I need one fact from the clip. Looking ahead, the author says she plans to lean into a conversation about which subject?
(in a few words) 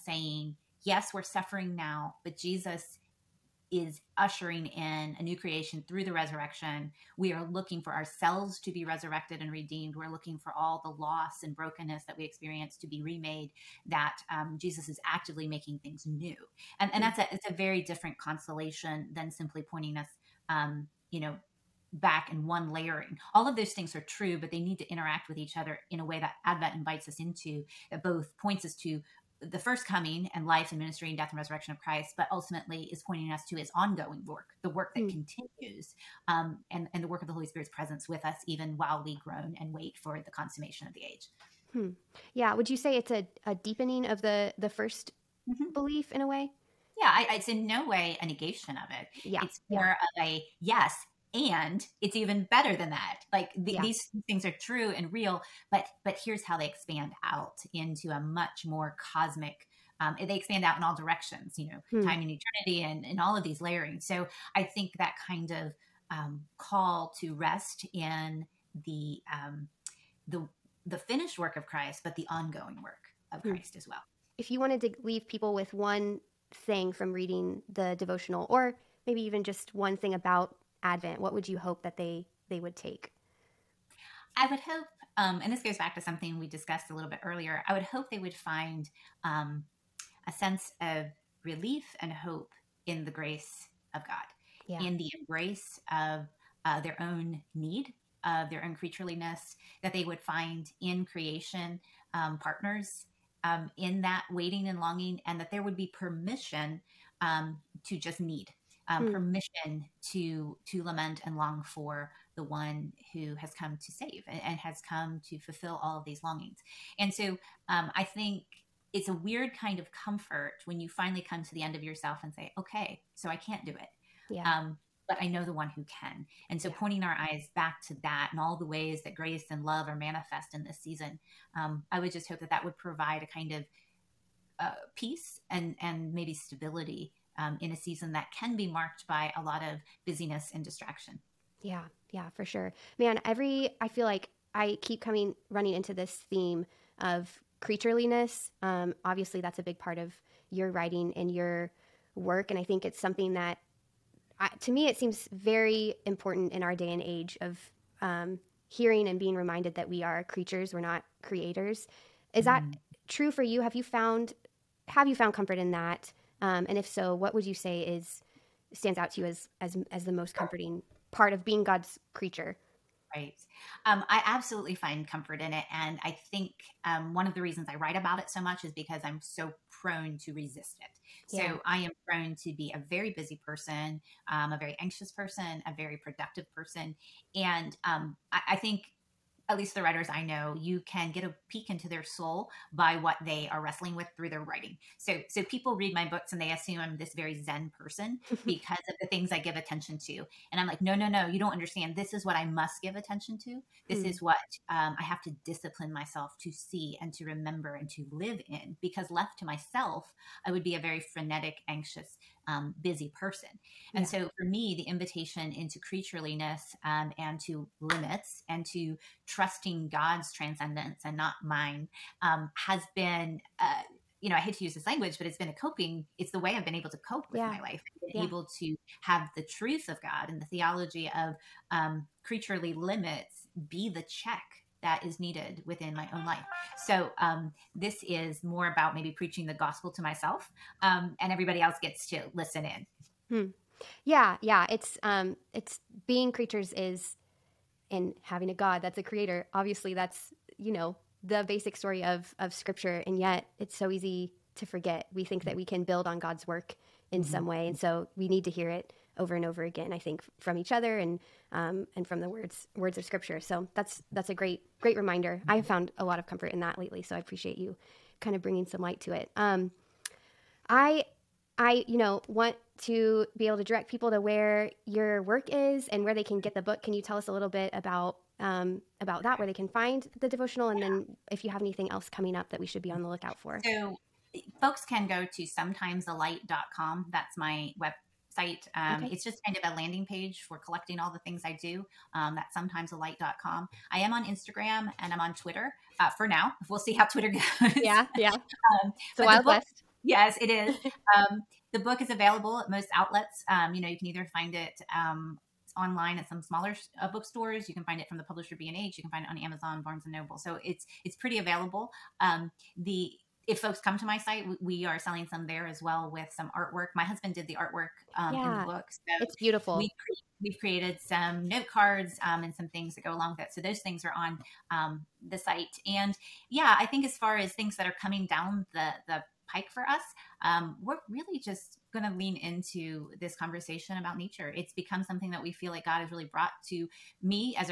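nature.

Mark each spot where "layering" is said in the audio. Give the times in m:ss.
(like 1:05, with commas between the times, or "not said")
0:22, 1:03.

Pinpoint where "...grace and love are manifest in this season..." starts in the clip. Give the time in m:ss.
2:09.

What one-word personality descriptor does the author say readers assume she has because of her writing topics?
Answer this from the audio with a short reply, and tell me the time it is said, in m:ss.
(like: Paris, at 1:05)
zen, at 3:17.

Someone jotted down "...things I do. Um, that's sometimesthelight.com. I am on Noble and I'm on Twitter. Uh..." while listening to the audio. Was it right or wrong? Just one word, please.
wrong.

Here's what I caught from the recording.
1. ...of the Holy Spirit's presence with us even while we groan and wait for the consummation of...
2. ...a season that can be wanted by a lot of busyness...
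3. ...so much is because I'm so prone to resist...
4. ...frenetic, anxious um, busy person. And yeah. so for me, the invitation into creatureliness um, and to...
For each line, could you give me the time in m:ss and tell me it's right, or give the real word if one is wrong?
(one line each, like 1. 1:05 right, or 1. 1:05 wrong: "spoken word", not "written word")
1. 0:37 right
2. 2:17 wrong: "marked", not "wanted"
3. 2:58 right
4. 3:31 right.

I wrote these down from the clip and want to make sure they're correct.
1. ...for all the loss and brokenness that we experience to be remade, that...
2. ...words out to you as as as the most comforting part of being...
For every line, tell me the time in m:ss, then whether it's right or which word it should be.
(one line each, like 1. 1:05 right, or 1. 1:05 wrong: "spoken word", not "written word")
1. 0:10 right
2. 2:48 wrong: "stands", not "words".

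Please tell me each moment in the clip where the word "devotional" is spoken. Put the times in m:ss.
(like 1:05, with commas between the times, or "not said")
1:17, 4:40.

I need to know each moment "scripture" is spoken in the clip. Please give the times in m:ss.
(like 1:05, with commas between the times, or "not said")
4:12, 4:23.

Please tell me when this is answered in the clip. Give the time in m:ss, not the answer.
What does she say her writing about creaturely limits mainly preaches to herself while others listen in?
3:59.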